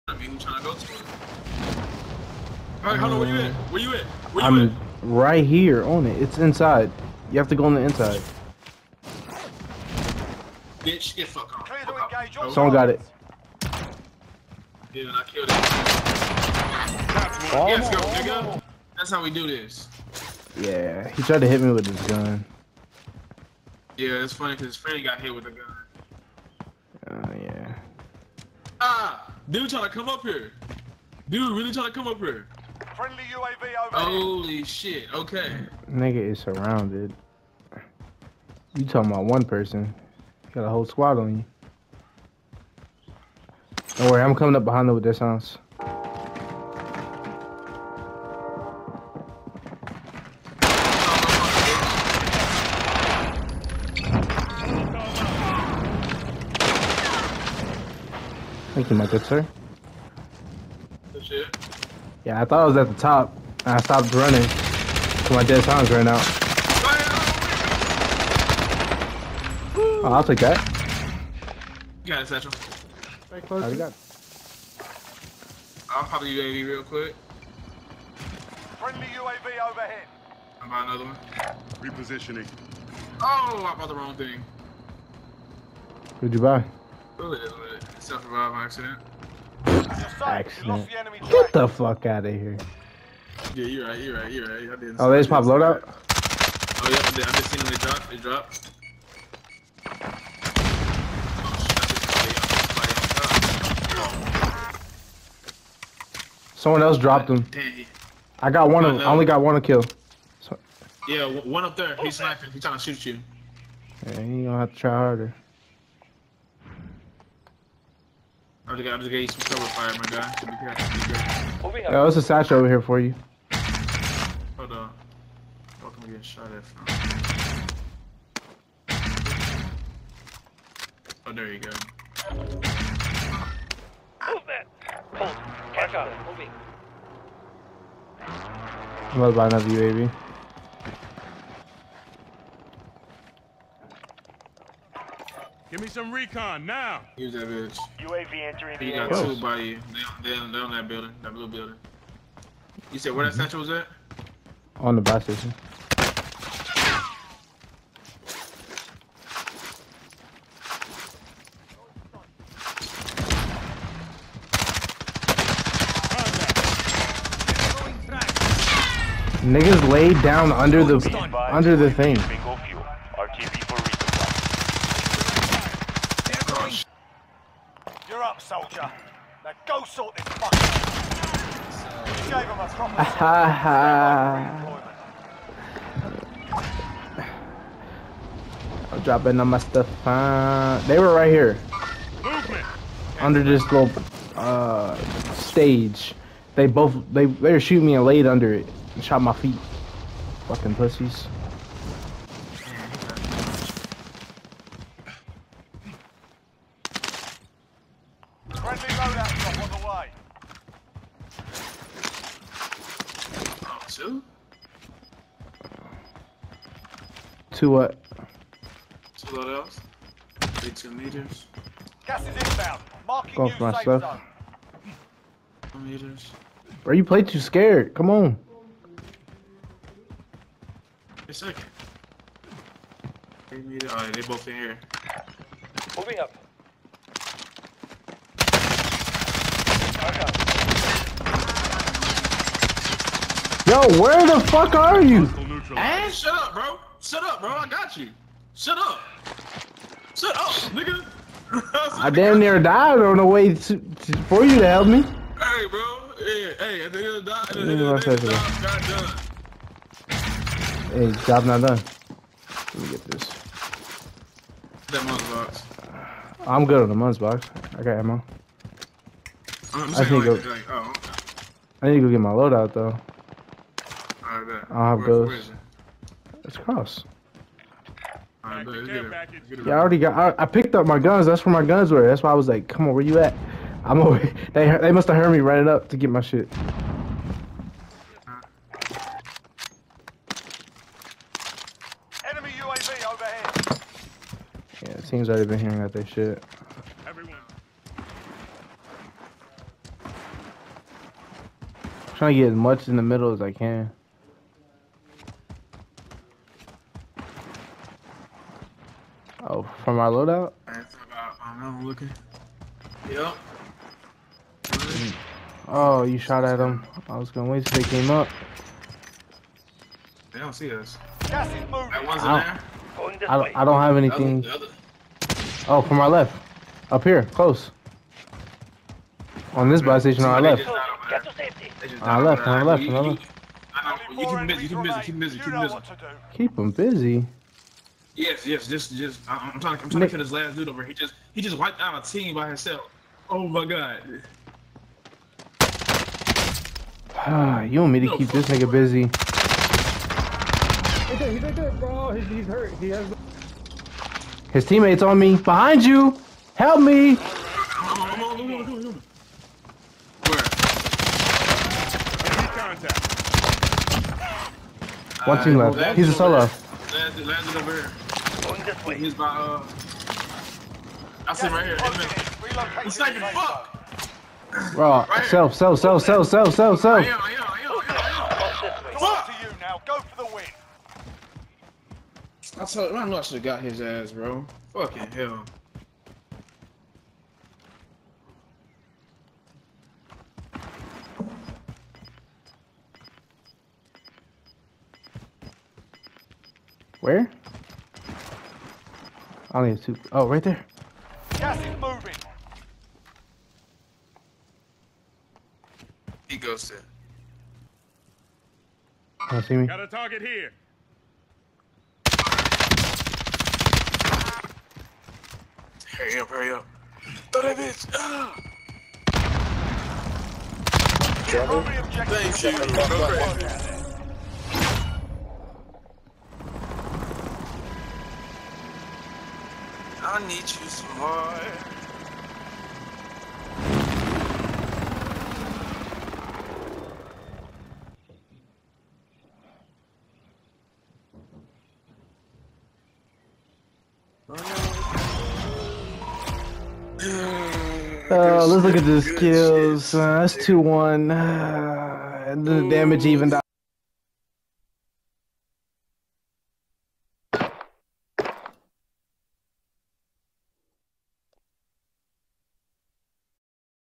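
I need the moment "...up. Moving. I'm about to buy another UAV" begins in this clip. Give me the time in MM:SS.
02:15.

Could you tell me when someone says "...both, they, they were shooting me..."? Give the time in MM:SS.
03:16.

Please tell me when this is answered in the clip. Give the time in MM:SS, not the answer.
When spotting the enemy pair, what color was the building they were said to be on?
02:31.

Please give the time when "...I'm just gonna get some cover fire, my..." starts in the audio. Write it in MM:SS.
01:58.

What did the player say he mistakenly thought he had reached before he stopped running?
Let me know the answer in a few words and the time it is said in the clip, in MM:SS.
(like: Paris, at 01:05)
The top, at 01:02.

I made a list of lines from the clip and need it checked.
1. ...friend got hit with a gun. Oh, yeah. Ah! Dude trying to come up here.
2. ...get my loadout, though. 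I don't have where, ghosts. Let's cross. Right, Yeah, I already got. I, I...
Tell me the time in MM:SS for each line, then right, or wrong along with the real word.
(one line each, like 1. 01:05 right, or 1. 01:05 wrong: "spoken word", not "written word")
1. 00:24 right
2. 04:32 right.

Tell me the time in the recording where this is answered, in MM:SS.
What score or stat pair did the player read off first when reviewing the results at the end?
07:30.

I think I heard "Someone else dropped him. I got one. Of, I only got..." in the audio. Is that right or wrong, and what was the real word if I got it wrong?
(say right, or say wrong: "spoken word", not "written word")
right.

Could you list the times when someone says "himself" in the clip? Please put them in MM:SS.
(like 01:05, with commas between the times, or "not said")
05:42.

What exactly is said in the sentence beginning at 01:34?
I didn't oh, they just pop loadout?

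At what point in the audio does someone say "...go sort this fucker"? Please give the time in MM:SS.
02:59.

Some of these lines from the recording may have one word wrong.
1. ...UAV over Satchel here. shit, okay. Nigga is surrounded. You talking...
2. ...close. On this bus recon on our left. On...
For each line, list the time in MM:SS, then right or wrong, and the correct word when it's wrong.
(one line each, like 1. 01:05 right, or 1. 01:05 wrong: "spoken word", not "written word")
1. 00:33 wrong: "Holy", not "Satchel"
2. 05:27 wrong: "station", not "recon".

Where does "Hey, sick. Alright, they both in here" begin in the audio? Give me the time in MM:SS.
03:51.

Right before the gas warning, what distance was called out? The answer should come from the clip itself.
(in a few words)
18 meters.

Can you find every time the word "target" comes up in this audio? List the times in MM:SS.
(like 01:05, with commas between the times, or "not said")
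06:49.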